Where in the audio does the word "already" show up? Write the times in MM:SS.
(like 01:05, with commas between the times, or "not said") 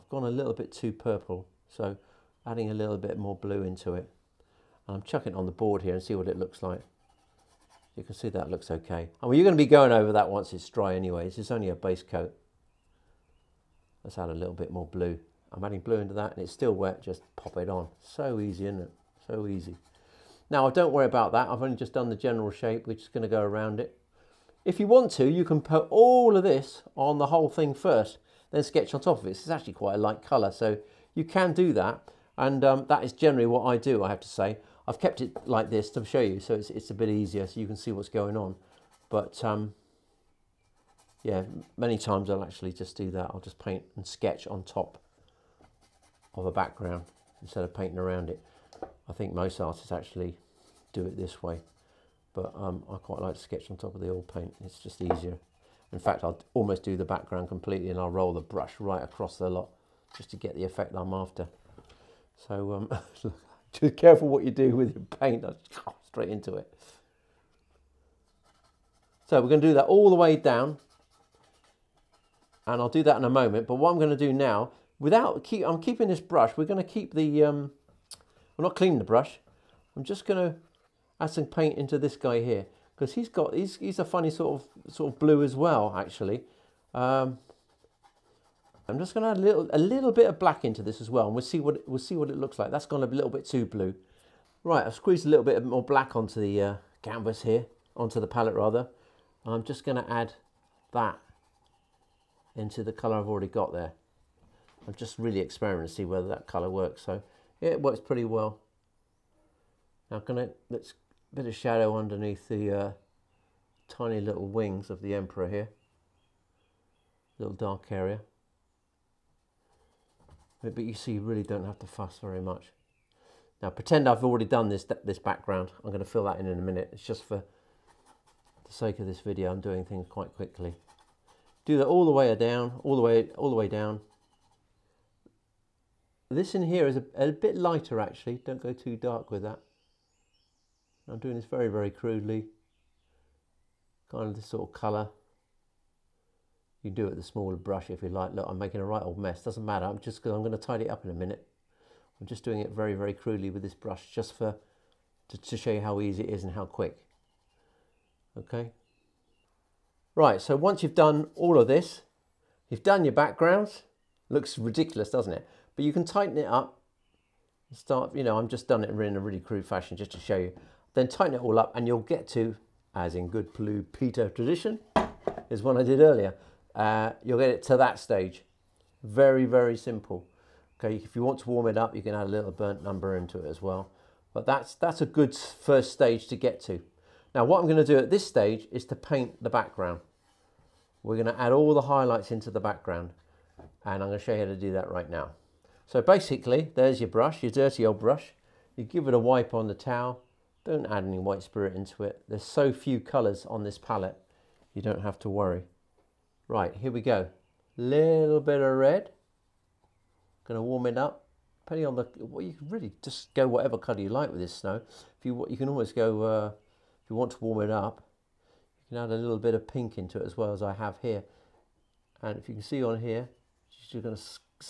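01:43, 02:04.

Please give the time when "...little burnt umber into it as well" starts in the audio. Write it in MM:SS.
03:02.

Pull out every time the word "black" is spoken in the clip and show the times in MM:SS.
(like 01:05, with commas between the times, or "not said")
01:30, 01:35.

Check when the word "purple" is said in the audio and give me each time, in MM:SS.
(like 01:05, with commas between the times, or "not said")
00:00.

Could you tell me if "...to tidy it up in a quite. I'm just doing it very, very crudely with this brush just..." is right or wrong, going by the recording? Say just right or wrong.
wrong.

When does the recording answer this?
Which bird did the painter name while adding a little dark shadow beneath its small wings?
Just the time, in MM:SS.
01:55.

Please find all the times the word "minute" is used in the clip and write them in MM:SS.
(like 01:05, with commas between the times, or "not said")
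02:06, 02:31.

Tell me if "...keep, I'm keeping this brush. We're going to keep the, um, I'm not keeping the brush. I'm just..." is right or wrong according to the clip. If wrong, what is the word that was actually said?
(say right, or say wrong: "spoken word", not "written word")
wrong: "cleaning", not "keeping".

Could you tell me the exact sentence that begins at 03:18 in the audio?
You give it a wipe on the towel don't add any white spirit into it.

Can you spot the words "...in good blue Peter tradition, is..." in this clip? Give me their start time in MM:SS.
02:53.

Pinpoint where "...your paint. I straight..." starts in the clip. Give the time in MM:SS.
01:04.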